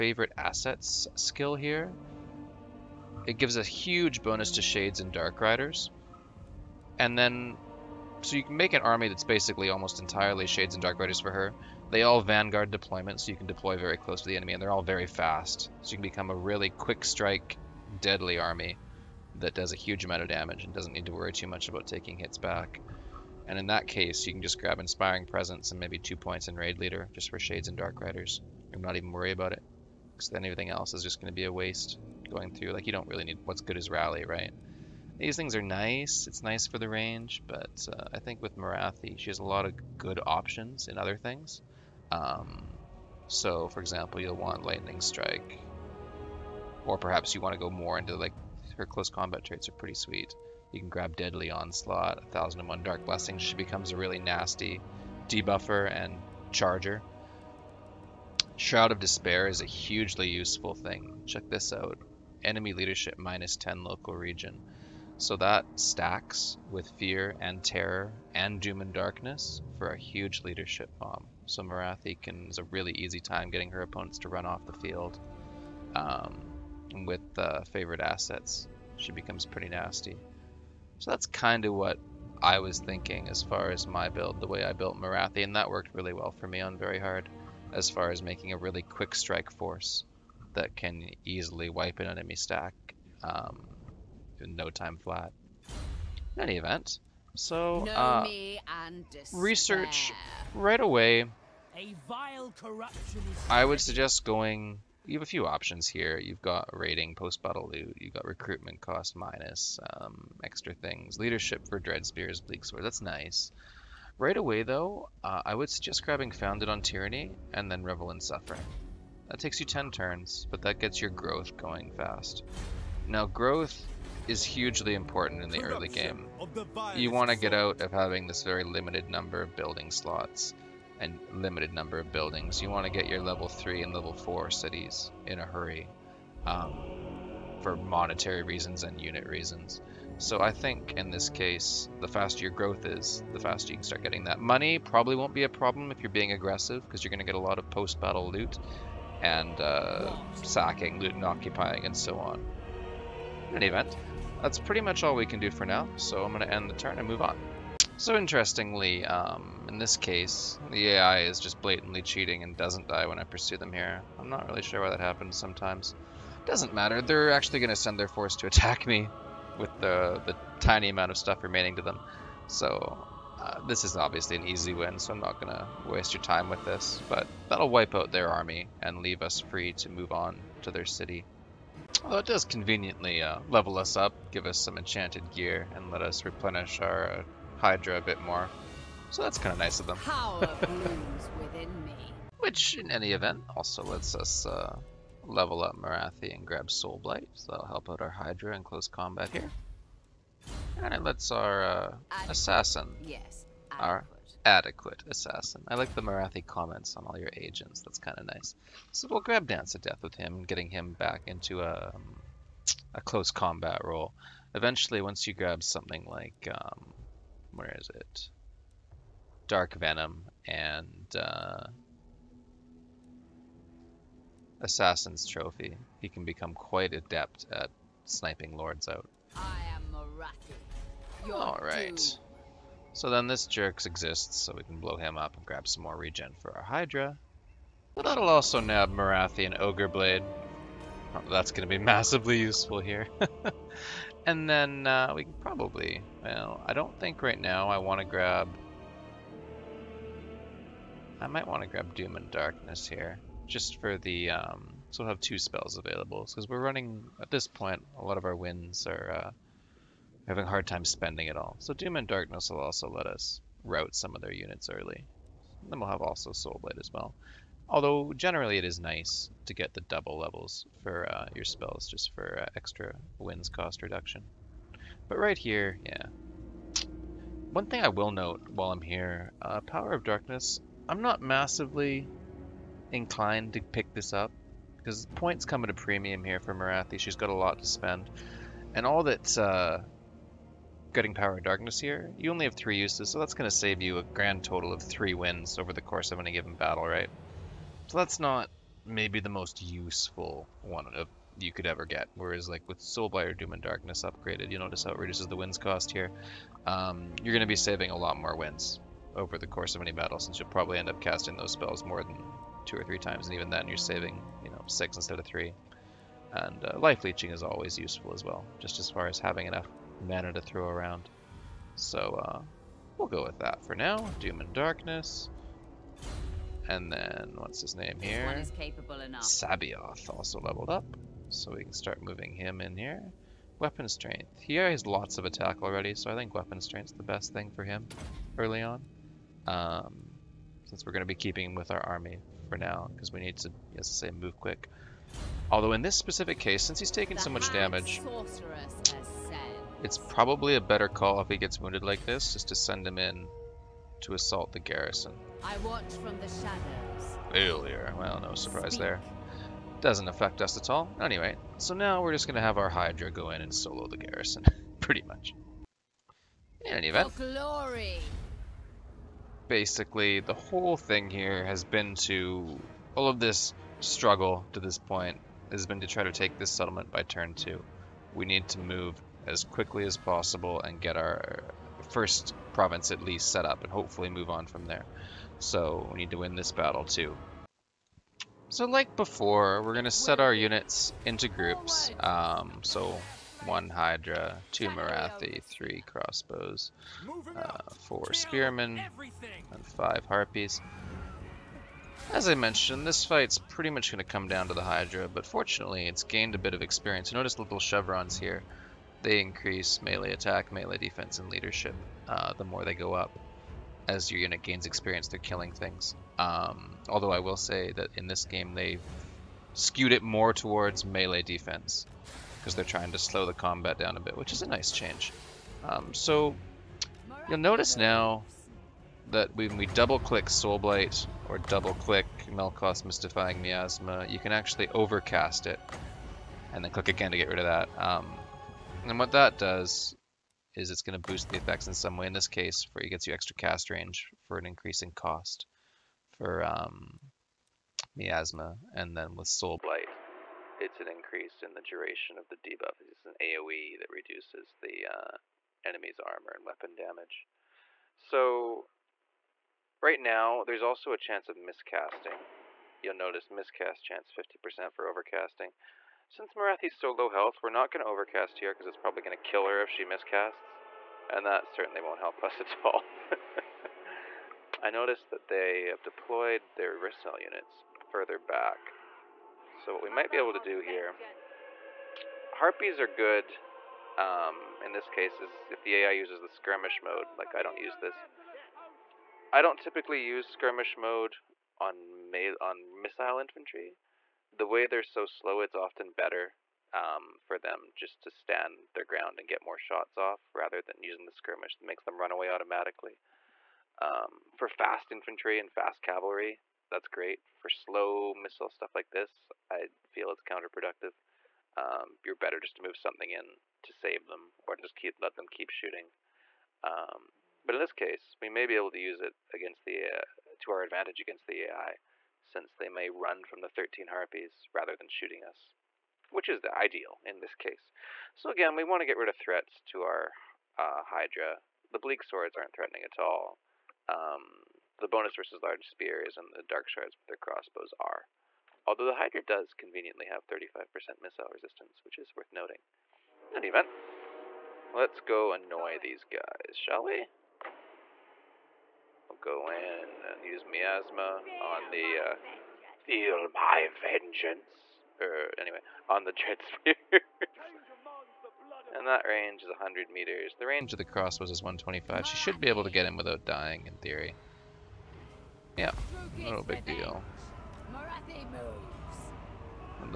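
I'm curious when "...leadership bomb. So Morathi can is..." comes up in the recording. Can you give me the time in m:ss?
1:10.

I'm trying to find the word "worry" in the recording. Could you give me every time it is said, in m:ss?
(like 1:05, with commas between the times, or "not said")
0:21, 0:29.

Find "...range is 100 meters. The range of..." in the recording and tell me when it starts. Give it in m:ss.
9:19.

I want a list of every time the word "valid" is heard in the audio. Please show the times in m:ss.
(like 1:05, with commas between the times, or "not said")
not said.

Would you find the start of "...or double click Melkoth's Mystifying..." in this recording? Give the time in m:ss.
7:11.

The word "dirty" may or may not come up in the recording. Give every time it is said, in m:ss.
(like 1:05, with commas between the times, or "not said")
not said.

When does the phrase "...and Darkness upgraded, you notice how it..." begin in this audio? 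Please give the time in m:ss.
5:03.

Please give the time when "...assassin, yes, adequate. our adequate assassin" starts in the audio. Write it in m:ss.
3:22.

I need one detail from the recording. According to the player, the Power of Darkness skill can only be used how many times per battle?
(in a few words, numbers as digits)
3.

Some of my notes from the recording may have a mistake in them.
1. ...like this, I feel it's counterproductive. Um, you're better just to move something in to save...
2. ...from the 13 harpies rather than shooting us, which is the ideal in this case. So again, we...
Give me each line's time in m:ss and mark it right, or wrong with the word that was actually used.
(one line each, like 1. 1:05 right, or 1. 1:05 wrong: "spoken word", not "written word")
1. 8:28 right
2. 8:43 right.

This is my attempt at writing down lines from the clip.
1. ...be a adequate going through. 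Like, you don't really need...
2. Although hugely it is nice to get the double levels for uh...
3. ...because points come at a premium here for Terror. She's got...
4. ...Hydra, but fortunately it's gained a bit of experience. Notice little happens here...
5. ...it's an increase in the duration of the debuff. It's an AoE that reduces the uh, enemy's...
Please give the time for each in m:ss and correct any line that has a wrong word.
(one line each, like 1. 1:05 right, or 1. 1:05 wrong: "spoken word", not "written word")
1. 0:31 wrong: "waste", not "adequate"
2. 4:27 wrong: "generally", not "hugely"
3. 4:44 wrong: "Morathi", not "Terror"
4. 6:44 wrong: "chevrons", not "happens"
5. 7:30 right.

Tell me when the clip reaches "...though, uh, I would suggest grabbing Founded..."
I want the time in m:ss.
1:54.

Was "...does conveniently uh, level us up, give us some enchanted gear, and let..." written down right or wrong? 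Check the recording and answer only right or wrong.
right.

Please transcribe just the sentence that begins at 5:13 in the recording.
And even then you're saving, you know, six instead of three.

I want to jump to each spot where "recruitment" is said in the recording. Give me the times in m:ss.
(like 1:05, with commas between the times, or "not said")
1:48.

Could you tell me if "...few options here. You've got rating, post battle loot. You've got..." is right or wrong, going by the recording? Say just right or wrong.
right.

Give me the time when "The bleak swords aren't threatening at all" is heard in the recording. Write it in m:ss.
8:51.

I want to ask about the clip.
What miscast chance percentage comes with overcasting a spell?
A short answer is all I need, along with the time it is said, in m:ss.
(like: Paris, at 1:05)
50%, at 7:44.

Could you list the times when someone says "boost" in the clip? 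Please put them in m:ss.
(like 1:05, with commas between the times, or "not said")
7:21.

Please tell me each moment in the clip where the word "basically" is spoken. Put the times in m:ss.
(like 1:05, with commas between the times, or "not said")
0:09, 6:09.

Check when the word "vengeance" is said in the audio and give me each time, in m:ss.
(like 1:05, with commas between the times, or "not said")
9:13.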